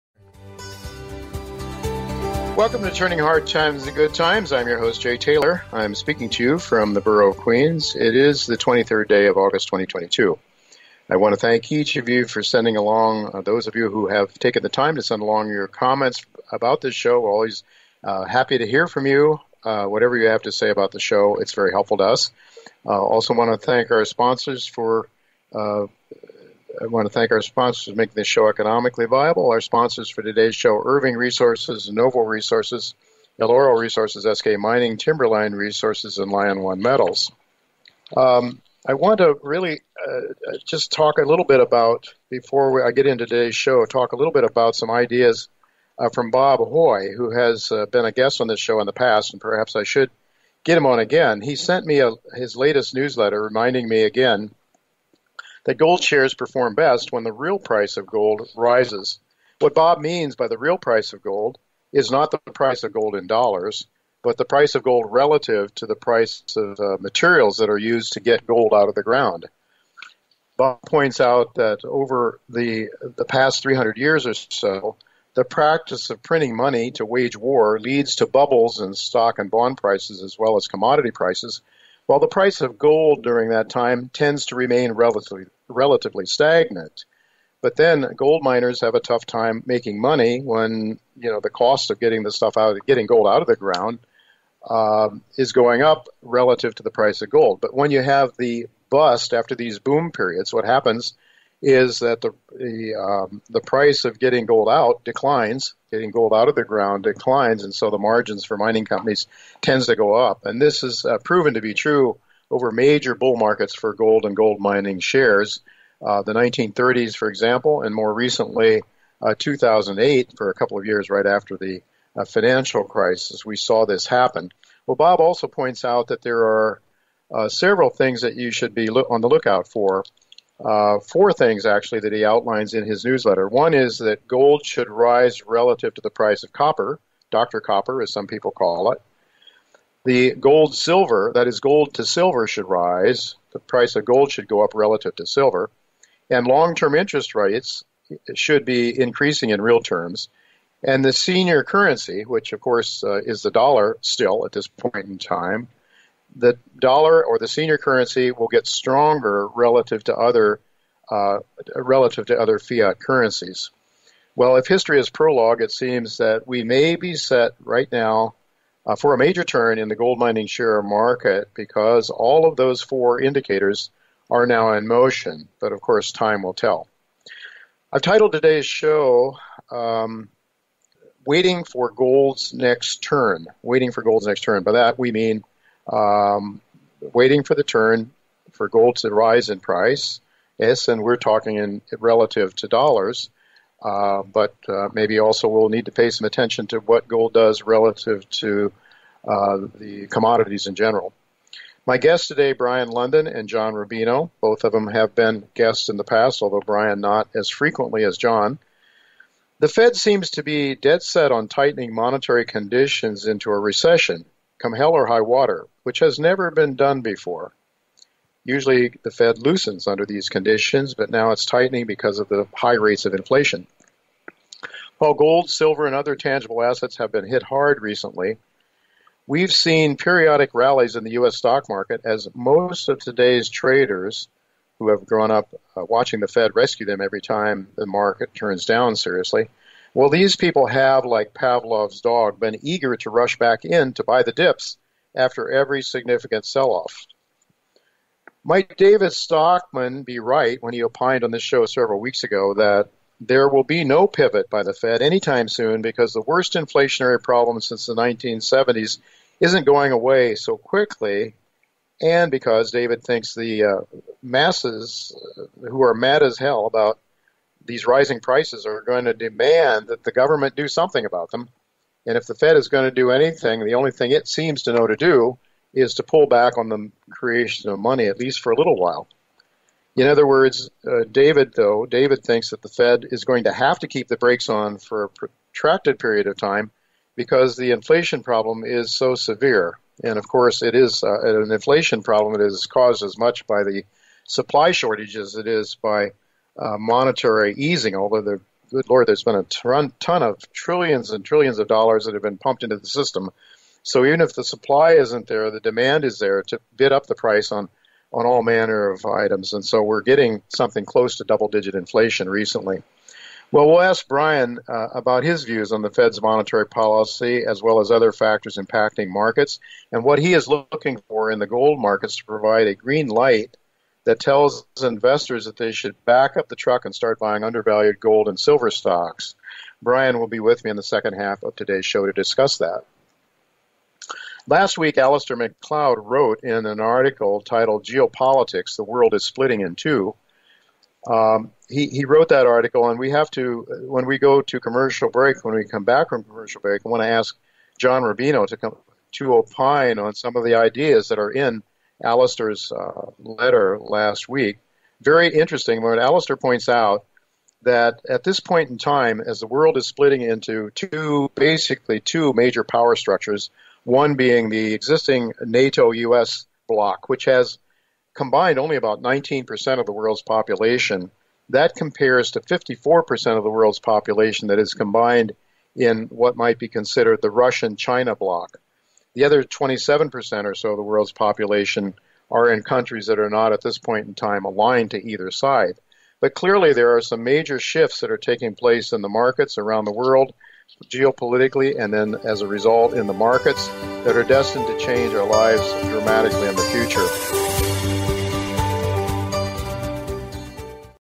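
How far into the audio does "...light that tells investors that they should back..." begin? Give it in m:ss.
5:23.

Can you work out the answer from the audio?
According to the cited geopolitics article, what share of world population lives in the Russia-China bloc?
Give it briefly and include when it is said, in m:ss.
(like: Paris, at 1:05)
54%, at 6:12.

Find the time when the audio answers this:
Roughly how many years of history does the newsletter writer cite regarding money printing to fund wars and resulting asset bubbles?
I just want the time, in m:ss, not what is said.
1:13.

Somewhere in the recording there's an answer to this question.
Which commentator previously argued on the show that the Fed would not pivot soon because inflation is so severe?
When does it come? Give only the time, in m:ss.
4:08.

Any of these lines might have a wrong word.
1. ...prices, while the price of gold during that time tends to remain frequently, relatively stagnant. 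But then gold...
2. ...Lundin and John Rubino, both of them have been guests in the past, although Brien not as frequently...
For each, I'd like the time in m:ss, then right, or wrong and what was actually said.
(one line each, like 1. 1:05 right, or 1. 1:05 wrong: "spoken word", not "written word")
1. 1:21 wrong: "relatively", not "frequently"
2. 3:22 right.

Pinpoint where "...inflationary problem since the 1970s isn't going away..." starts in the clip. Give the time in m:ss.
4:16.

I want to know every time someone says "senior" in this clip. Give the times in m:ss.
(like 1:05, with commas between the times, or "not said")
2:31, 2:37.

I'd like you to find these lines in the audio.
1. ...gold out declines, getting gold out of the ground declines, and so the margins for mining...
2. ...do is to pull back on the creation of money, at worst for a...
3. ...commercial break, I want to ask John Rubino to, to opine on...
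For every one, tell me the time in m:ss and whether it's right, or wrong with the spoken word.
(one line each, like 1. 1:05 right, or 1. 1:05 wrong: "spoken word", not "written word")
1. 1:44 right
2. 4:34 wrong: "least", not "worst"
3. 5:46 right.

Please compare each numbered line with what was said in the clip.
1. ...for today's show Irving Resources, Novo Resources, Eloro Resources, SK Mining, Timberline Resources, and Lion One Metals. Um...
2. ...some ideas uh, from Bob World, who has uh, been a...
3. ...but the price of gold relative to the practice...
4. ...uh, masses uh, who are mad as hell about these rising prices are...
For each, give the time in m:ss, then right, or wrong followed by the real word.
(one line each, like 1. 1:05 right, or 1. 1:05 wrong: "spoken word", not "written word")
1. 0:30 right
2. 0:44 wrong: "Hoye", not "World"
3. 1:04 wrong: "price", not "practice"
4. 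4:23 right.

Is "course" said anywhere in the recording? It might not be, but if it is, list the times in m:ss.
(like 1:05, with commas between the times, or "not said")
2:32, 2:55, 4:50.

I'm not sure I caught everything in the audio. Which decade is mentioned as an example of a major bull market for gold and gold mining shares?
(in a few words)
1930s.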